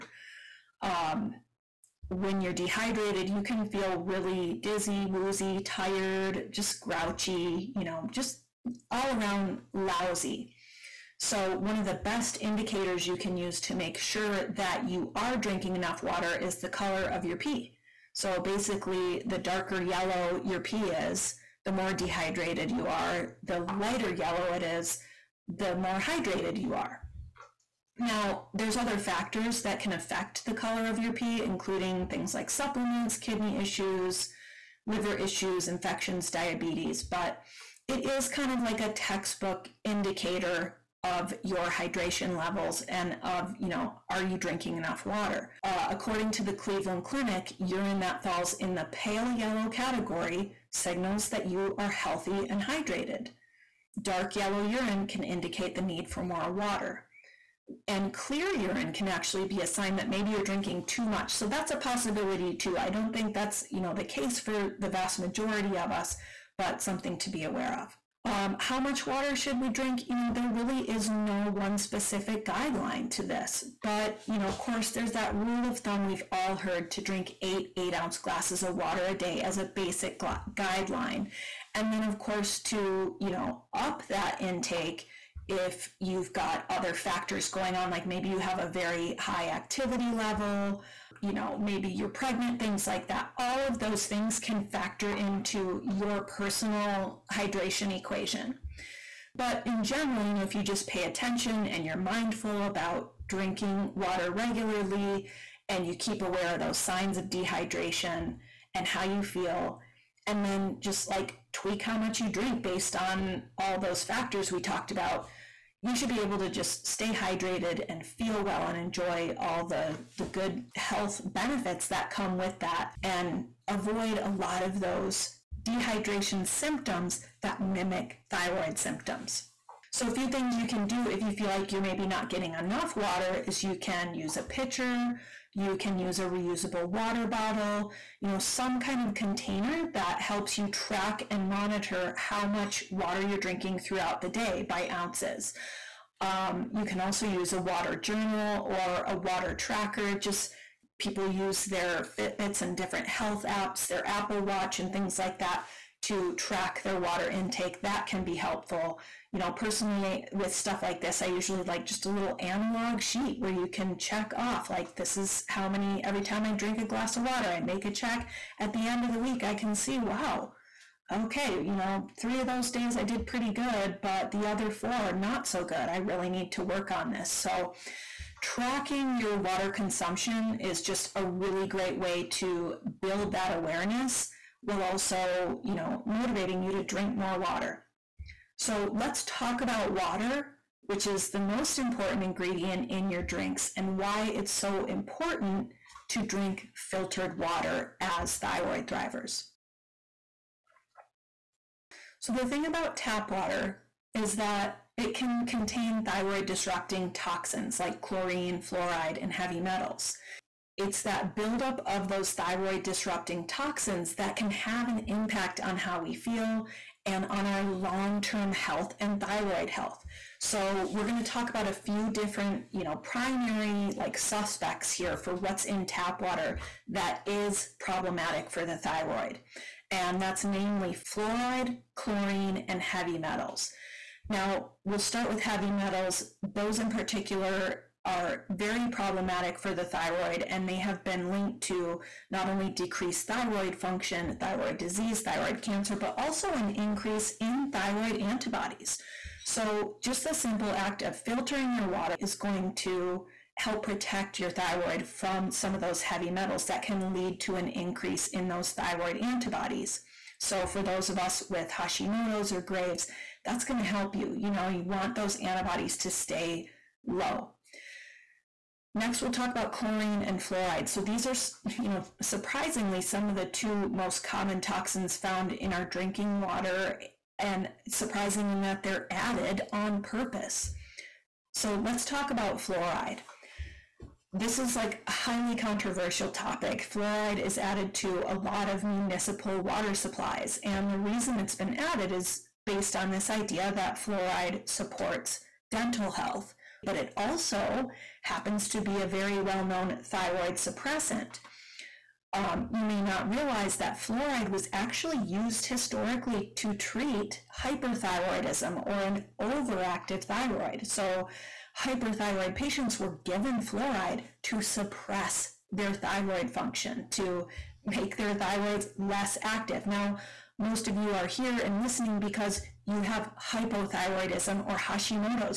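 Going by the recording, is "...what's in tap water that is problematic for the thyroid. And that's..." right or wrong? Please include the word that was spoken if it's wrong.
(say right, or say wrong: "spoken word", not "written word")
right.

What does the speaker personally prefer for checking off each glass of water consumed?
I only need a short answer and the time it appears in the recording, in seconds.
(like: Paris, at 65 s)
analog sheet, at 162 s.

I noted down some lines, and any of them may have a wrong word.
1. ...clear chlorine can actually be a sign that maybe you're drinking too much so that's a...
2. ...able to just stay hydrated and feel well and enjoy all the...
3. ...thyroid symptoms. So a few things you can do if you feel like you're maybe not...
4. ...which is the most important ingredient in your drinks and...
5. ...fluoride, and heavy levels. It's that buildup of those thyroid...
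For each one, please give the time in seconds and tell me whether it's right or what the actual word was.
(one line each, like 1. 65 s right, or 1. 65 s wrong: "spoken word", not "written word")
1. 58 s wrong: "urine", not "chlorine"
2. 116 s right
3. 128 s right
4. 190 s right
5. 208 s wrong: "metals", not "levels".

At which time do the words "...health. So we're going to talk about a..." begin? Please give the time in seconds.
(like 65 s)
219 s.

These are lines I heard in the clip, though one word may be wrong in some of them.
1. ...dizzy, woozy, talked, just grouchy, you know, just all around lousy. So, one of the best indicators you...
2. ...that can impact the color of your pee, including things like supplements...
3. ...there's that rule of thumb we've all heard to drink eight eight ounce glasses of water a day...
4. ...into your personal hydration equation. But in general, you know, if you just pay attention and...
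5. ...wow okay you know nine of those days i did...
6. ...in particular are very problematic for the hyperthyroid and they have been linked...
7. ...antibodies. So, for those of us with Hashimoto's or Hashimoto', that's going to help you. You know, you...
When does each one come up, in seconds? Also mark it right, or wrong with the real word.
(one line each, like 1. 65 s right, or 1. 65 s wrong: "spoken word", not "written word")
1. 4 s wrong: "tired", not "talked"
2. 29 s wrong: "affect", not "impact"
3. 74 s right
4. 95 s right
5. 169 s wrong: "three", not "nine"
6. 236 s wrong: "thyroid", not "hyperthyroid"
7. 259 s wrong: "Graves", not "Hashimoto".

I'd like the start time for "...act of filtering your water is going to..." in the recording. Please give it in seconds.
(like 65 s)
250 s.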